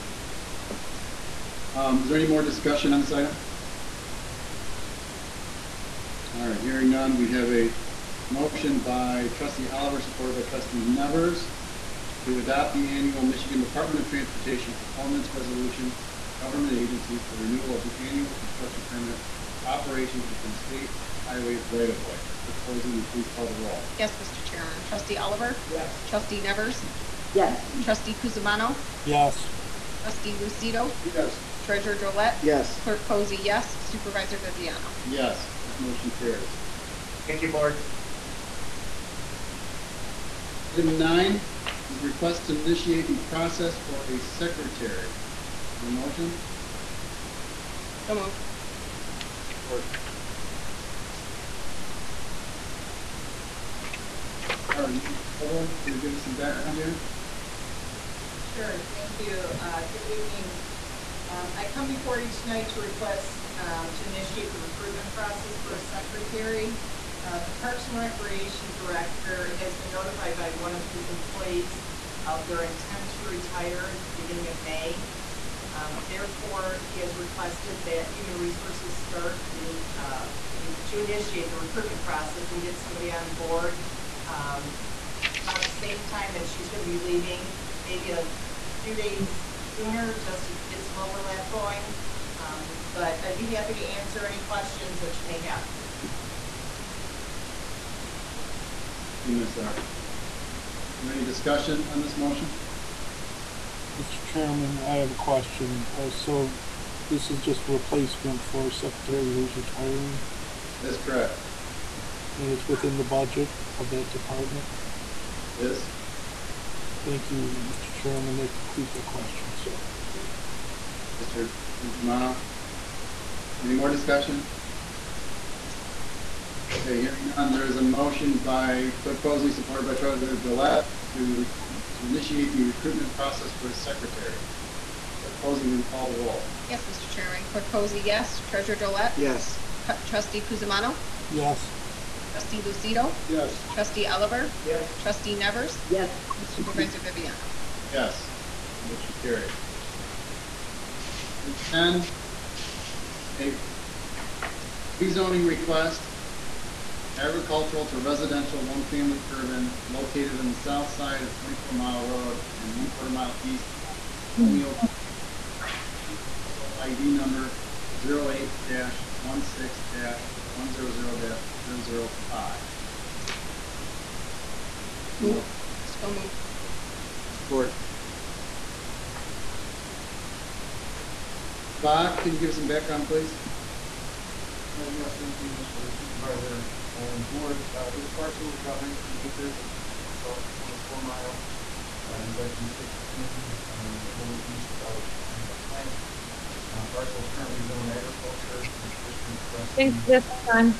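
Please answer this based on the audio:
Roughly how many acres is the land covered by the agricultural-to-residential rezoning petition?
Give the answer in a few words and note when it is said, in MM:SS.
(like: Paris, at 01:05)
19 acres, at 03:08.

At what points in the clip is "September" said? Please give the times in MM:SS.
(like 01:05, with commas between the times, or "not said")
not said.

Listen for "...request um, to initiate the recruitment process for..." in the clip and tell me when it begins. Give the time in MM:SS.
01:02.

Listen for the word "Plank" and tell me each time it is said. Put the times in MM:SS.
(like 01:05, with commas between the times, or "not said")
02:46, 03:15.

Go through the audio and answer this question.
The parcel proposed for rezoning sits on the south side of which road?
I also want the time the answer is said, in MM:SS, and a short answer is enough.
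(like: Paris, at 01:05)
24 Mile Road, at 02:41.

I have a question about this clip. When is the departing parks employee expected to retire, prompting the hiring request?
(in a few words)
beginning of May.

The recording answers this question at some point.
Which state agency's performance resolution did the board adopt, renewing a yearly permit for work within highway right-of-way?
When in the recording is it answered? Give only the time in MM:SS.
00:13.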